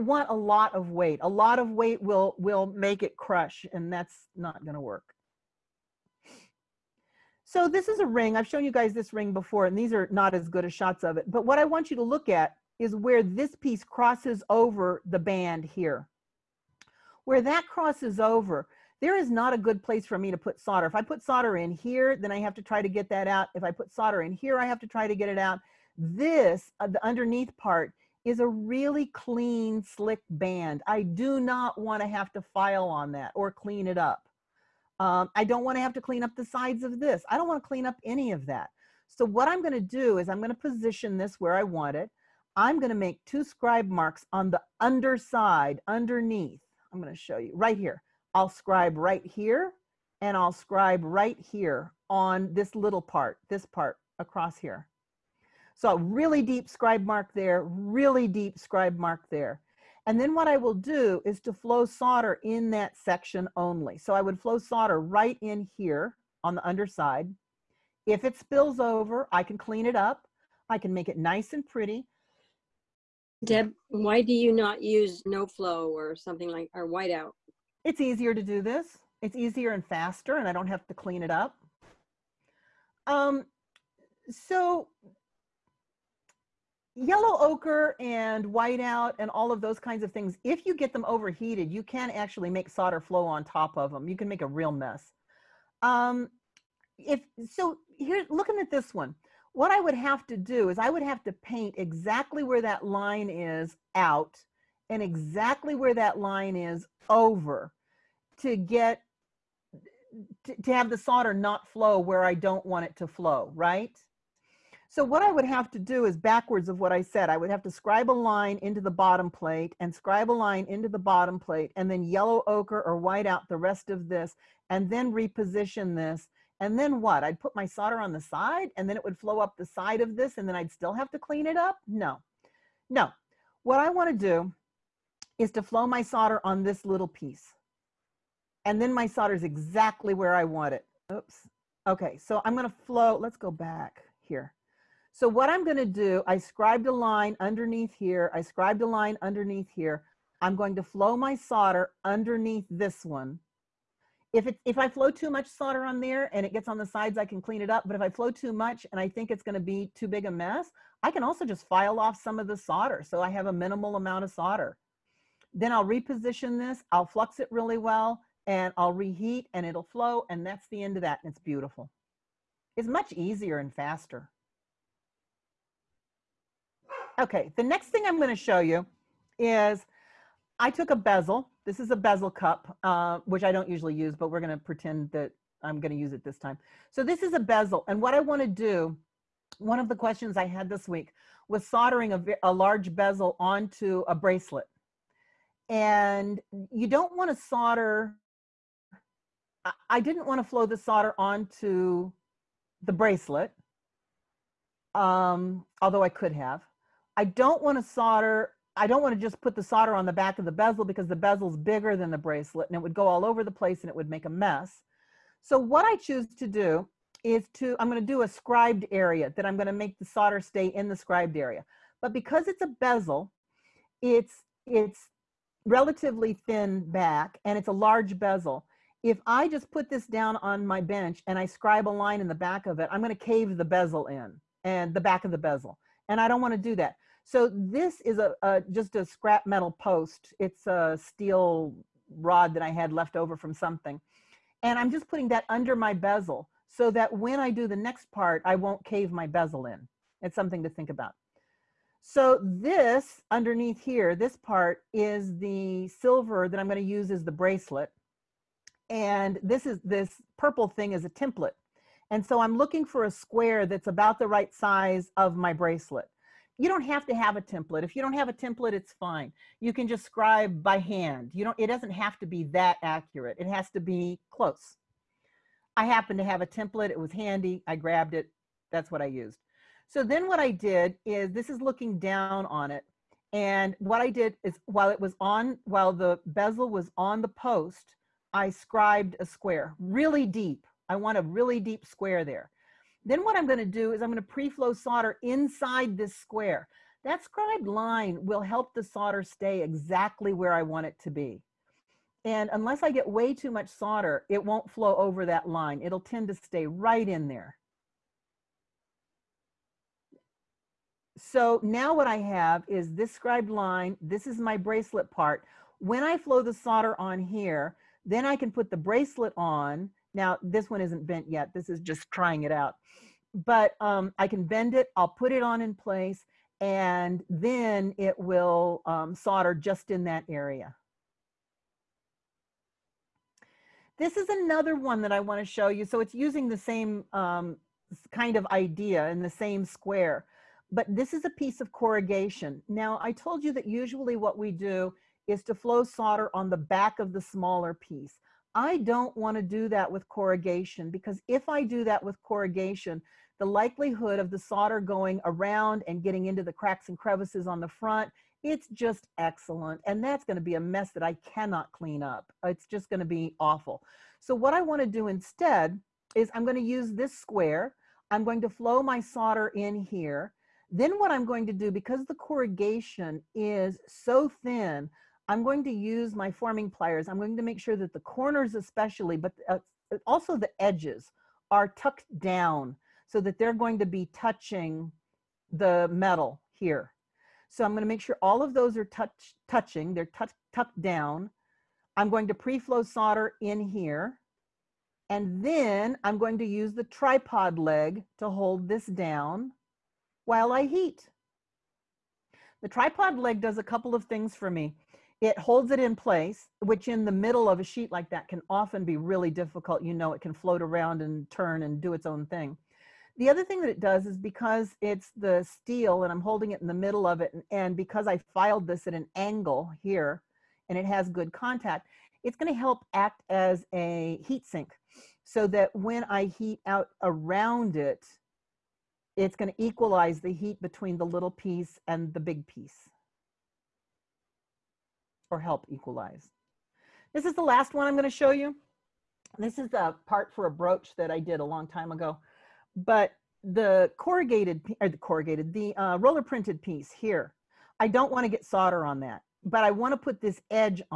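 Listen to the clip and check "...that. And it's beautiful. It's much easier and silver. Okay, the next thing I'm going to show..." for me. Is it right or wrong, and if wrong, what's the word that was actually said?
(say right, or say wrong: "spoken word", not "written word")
wrong: "faster", not "silver".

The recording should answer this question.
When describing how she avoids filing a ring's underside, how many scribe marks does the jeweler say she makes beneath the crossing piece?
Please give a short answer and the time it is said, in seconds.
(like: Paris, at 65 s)
2, at 43 s.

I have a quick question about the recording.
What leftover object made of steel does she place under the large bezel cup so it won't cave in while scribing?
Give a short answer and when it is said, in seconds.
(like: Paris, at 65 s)
Steel rod, at 241 s.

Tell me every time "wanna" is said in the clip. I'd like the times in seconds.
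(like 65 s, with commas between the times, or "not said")
133 s, 335 s.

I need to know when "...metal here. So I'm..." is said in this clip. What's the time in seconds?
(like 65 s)
385 s.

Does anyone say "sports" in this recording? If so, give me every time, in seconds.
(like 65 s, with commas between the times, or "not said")
not said.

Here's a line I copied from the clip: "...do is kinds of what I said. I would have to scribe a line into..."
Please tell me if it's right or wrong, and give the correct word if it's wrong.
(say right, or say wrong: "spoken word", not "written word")
wrong: "backwards", not "kinds".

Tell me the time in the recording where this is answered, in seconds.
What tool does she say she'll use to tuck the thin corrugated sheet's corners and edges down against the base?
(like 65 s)
376 s.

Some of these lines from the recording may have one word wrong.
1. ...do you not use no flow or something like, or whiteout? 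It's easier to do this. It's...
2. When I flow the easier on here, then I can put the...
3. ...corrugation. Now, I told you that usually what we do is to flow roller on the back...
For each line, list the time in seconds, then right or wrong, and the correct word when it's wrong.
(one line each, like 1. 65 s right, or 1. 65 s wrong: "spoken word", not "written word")
1. 74 s right
2. 315 s wrong: "solder", not "easier"
3. 341 s wrong: "solder", not "roller".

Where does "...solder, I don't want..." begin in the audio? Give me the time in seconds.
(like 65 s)
207 s.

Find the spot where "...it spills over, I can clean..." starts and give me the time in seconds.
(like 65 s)
68 s.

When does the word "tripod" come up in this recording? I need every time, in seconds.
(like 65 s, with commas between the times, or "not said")
396 s, 402 s.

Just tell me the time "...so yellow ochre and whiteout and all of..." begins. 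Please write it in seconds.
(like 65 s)
84 s.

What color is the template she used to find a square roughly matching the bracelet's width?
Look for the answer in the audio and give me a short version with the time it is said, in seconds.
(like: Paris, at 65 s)
Purple, at 260 s.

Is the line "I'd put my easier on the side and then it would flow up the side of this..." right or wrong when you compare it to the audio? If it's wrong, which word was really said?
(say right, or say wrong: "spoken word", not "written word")
wrong: "solder", not "easier".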